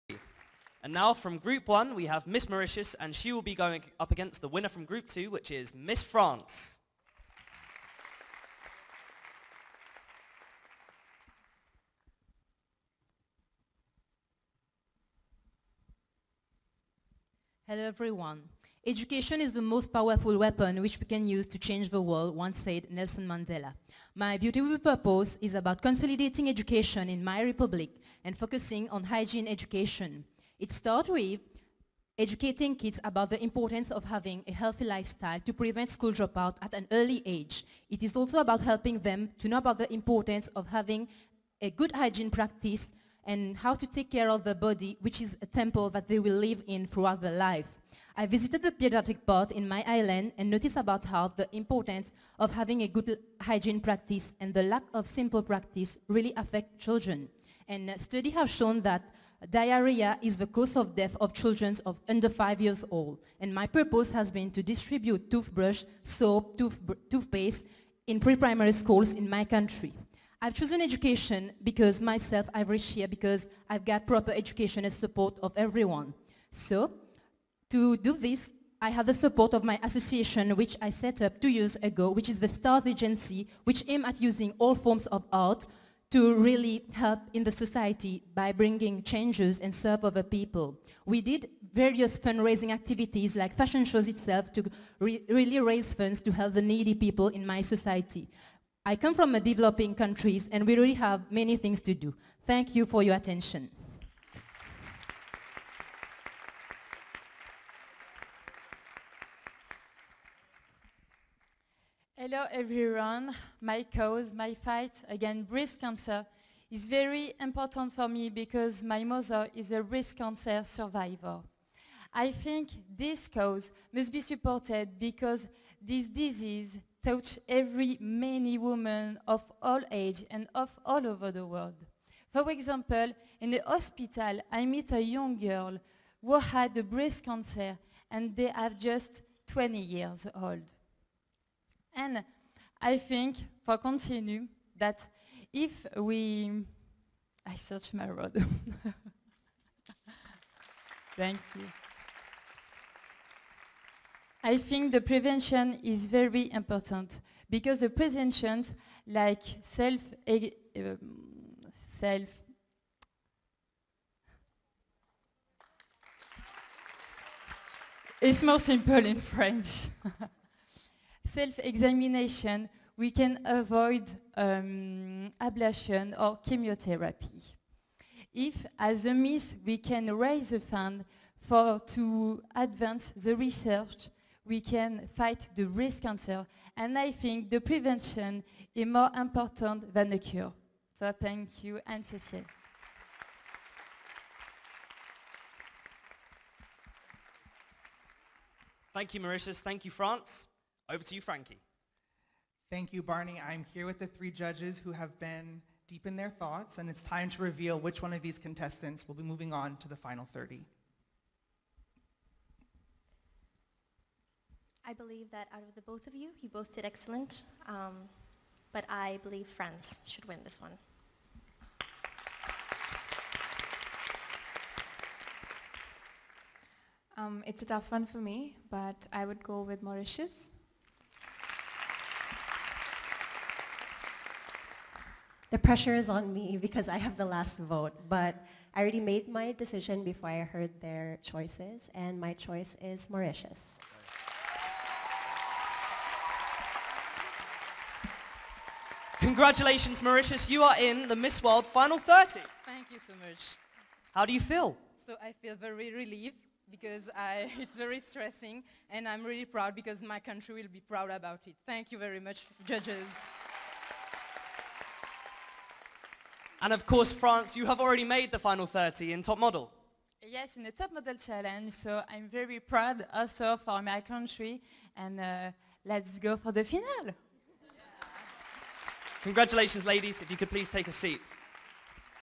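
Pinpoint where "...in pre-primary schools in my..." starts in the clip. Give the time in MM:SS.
01:08.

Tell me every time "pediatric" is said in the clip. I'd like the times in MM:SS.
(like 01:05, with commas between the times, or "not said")
00:48.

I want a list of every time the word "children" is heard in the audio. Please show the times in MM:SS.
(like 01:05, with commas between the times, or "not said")
00:56, 01:01.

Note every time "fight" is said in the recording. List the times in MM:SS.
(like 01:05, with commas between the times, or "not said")
01:54, 03:05.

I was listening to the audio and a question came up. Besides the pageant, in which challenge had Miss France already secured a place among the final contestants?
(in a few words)
Top Model Challenge.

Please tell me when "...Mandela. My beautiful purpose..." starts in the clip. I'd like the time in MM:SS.
00:23.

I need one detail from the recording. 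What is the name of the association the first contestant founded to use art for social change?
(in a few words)
STARS Agency.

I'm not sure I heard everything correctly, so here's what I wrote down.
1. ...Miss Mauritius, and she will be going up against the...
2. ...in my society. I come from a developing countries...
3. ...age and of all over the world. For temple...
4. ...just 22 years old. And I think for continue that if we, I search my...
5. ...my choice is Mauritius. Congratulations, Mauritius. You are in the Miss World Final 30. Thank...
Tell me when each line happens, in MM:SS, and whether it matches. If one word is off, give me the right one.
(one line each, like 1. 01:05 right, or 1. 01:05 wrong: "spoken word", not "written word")
1. 00:02 right
2. 01:37 right
3. 02:09 wrong: "example", not "temple"
4. 02:18 wrong: "20", not "22"
5. 04:02 right.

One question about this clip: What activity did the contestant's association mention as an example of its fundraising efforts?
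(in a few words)
fashion shows.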